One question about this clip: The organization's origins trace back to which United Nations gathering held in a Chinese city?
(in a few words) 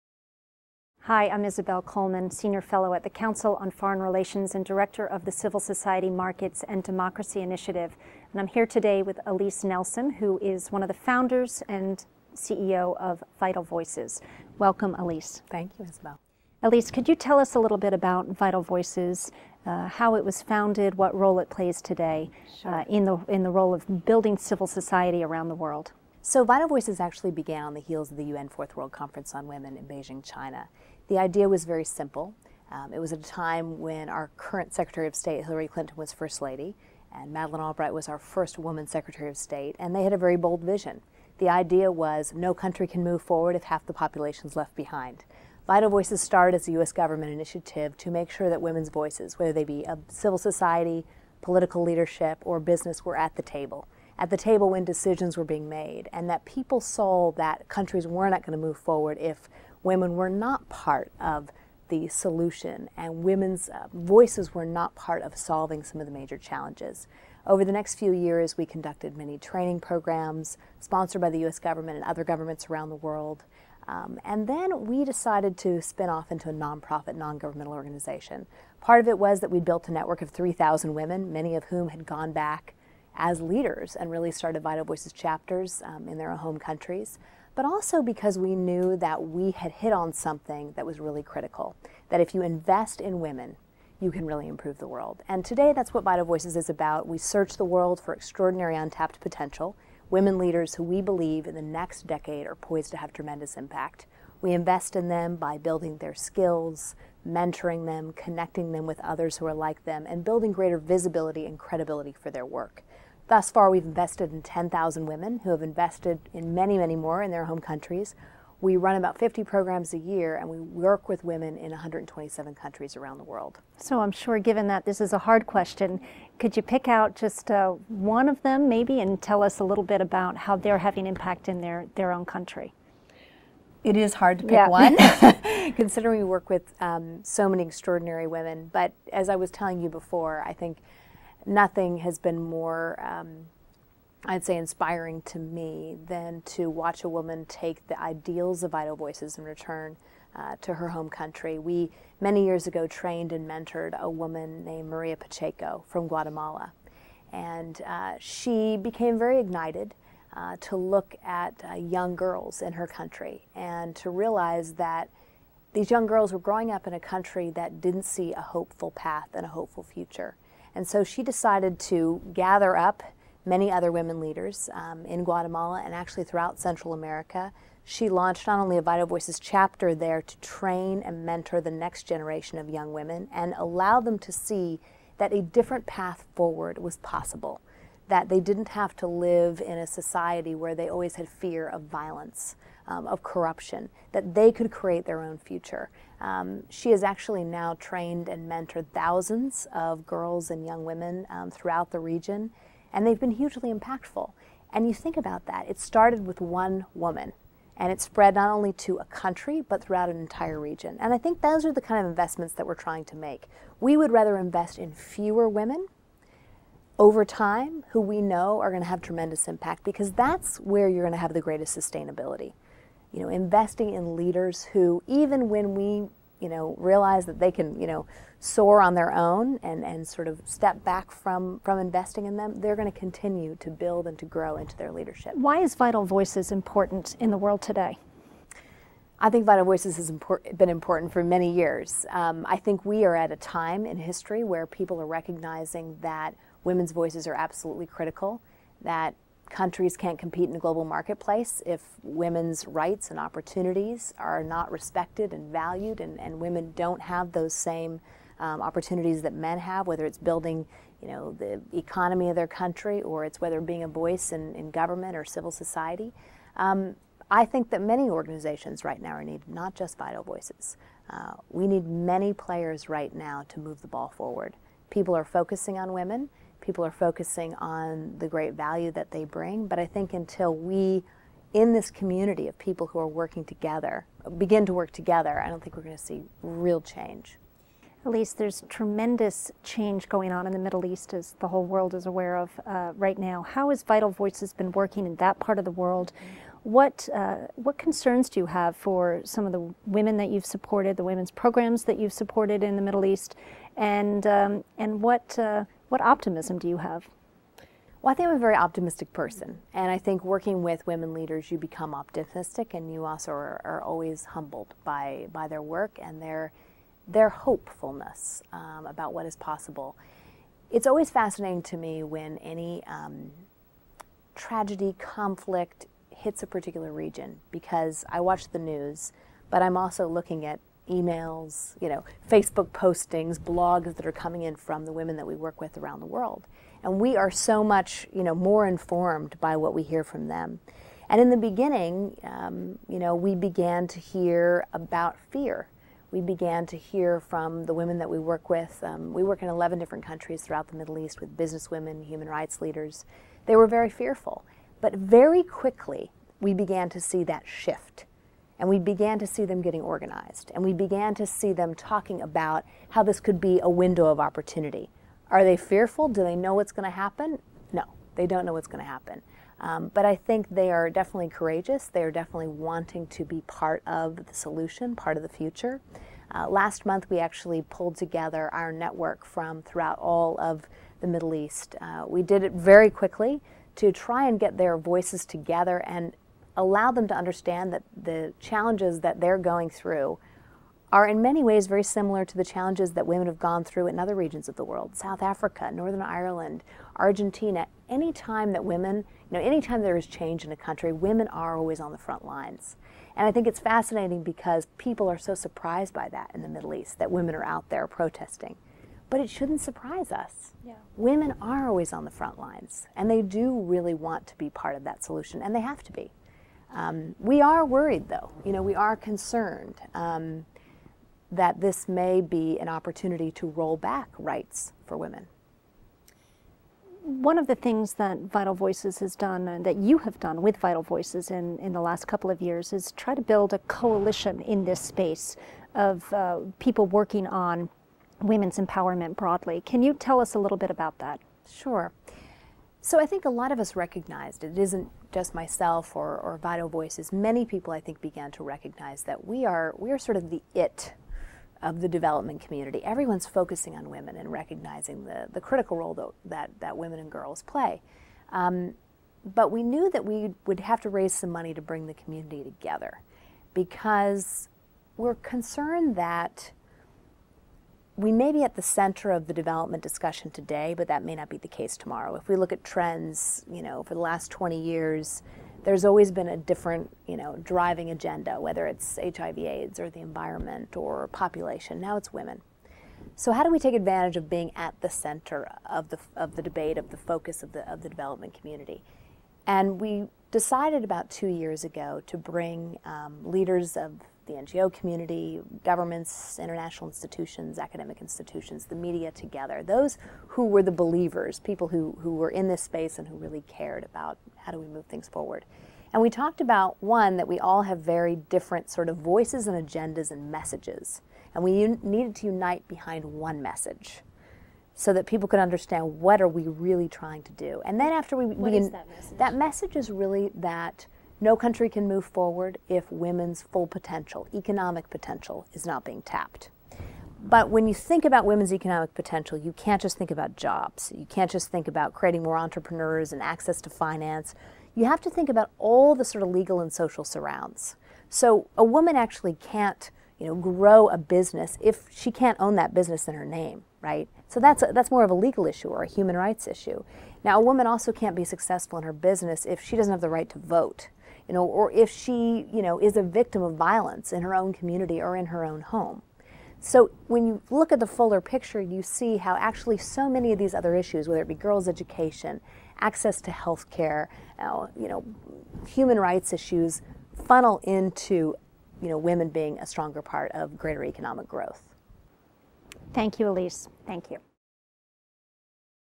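UN Fourth World Conference on Women.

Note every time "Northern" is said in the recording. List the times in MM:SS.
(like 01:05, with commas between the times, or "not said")
06:35.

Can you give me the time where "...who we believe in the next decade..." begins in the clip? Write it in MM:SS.
01:40.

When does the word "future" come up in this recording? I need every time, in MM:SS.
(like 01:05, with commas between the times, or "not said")
02:49, 03:15, 06:15.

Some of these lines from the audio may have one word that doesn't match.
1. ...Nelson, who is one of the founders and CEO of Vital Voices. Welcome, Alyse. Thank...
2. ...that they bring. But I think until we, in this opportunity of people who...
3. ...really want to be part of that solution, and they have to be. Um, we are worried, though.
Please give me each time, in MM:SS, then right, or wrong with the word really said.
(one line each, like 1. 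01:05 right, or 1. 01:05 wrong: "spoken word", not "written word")
1. 00:09 right
2. 04:38 wrong: "community", not "opportunity"
3. 06:53 right.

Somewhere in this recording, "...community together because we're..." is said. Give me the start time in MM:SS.
07:41.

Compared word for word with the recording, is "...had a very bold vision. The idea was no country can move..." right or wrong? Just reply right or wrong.
right.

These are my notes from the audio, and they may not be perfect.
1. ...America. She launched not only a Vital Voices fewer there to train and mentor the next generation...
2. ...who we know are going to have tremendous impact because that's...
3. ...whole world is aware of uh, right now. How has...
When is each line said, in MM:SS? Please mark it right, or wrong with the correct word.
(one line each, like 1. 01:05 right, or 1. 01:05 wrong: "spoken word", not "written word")
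1. 02:56 wrong: "chapter", not "fewer"
2. 03:37 right
3. 04:51 right.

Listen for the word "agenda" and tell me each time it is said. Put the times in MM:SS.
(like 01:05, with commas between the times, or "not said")
07:57, 08:29.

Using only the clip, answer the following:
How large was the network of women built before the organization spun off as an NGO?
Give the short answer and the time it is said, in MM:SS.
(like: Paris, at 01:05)
3,000, at 01:20.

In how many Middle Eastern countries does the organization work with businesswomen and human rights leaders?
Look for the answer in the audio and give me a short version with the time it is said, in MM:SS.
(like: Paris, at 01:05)
11, at 05:49.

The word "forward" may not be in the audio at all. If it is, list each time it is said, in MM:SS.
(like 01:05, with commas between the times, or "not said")
00:43, 00:58, 03:06, 04:34, 08:25, 08:42.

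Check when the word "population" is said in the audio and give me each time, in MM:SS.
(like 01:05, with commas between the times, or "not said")
00:43, 08:01.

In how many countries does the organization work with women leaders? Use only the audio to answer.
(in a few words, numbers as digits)
127.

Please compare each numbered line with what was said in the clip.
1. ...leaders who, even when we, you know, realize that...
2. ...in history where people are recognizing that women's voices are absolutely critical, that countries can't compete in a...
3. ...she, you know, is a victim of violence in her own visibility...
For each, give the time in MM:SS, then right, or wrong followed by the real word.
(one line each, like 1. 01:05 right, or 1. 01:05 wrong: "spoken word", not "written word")
1. 03:44 right
2. 04:03 right
3. 09:11 wrong: "community", not "visibility".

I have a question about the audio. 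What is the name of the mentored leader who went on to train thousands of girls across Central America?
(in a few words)
Maria Pacheco.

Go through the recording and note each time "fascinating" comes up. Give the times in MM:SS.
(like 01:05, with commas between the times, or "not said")
05:21, 06:43.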